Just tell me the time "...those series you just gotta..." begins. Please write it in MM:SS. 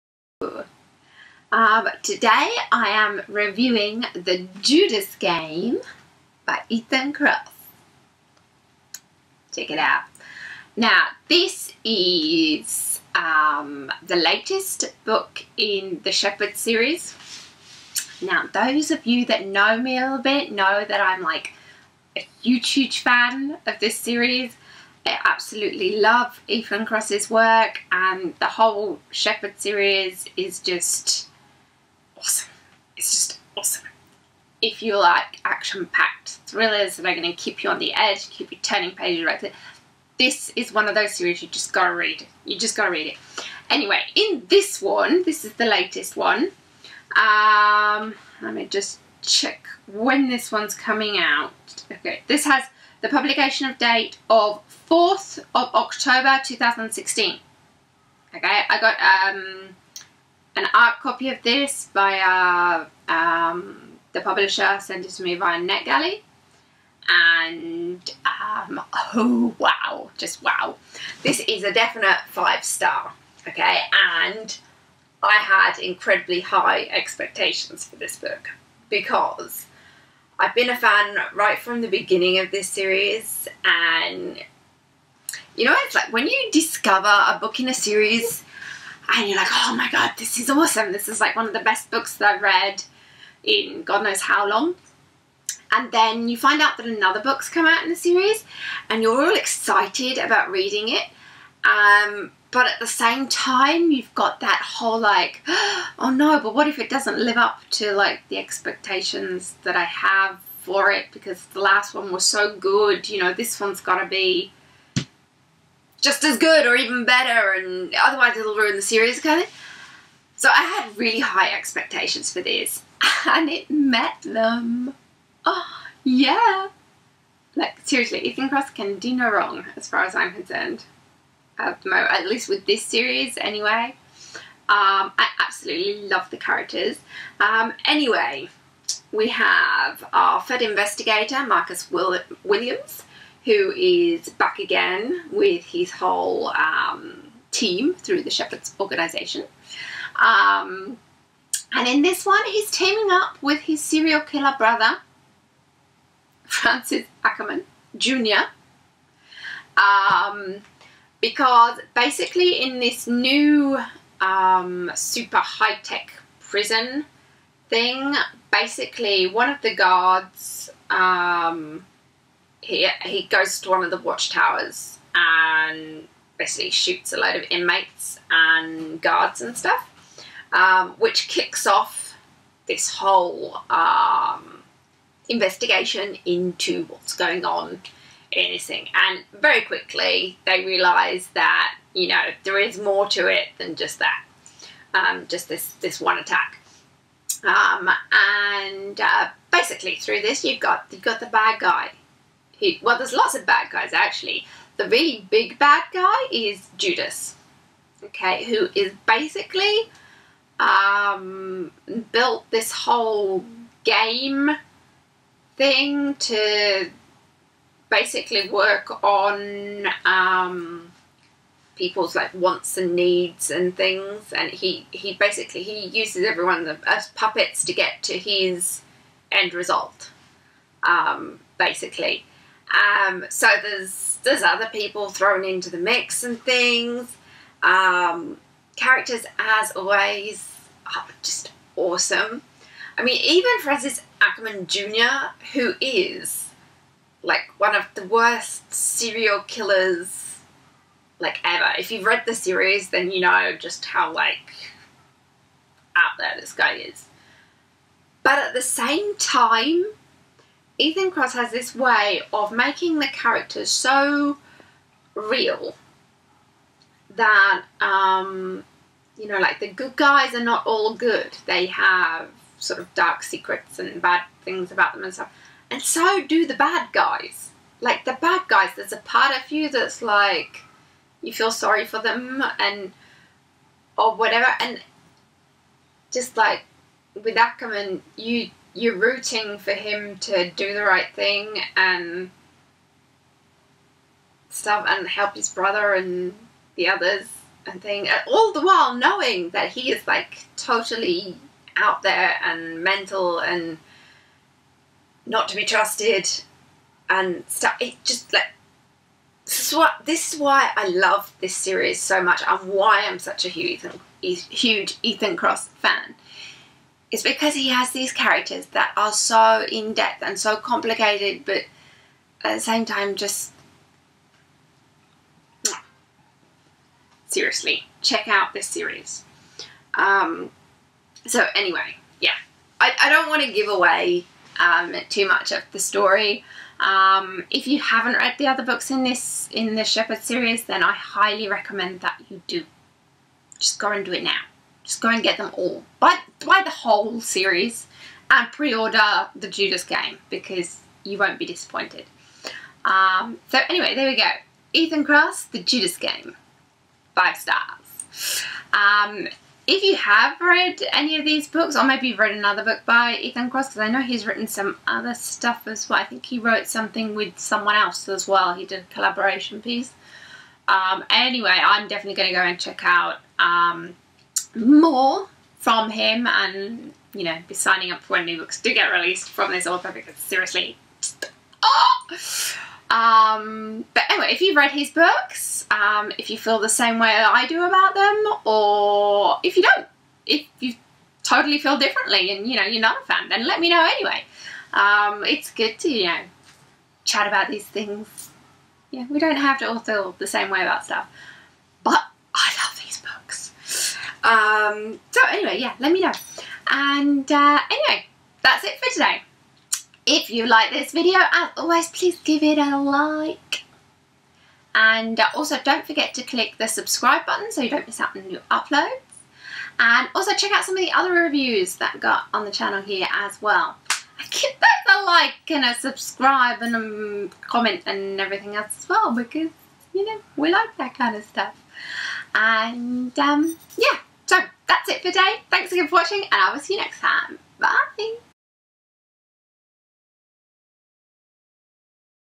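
00:40.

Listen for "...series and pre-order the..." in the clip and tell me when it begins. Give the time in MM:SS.
05:47.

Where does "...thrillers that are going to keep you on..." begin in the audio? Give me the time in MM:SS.
00:36.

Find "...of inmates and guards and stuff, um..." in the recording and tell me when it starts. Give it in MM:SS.
02:57.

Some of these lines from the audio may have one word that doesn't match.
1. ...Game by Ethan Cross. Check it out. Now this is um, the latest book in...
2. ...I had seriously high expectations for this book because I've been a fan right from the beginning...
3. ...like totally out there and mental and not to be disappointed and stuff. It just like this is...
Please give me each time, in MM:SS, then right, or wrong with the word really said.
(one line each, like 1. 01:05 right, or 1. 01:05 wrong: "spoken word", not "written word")
1. 00:05 right
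2. 01:15 wrong: "incredibly", not "seriously"
3. 05:00 wrong: "trusted", not "disappointed".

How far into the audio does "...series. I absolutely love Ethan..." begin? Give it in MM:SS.
00:23.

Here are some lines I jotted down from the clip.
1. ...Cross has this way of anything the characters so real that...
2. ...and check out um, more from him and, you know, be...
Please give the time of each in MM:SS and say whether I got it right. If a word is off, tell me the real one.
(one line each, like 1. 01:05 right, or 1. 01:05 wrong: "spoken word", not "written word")
1. 04:21 wrong: "making", not "anything"
2. 06:12 right.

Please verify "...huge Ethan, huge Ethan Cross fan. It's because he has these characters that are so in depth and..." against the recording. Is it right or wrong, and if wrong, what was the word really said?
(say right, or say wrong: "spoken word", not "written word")
right.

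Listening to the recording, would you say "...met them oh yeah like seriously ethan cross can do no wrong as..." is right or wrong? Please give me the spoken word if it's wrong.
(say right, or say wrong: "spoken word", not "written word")
right.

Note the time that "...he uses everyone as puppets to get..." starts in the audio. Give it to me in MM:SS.
03:45.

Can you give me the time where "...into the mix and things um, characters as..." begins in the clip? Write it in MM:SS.
03:55.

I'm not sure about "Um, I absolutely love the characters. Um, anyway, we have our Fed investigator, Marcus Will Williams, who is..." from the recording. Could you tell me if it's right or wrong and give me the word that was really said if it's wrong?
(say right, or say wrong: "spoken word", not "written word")
right.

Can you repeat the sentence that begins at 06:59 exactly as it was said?
And also check out some of the other reviews that got on the channel here as well.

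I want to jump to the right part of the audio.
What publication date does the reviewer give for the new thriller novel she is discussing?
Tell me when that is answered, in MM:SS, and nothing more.
00:54.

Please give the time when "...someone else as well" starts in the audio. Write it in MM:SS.
06:07.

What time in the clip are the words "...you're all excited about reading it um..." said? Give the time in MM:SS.
01:39.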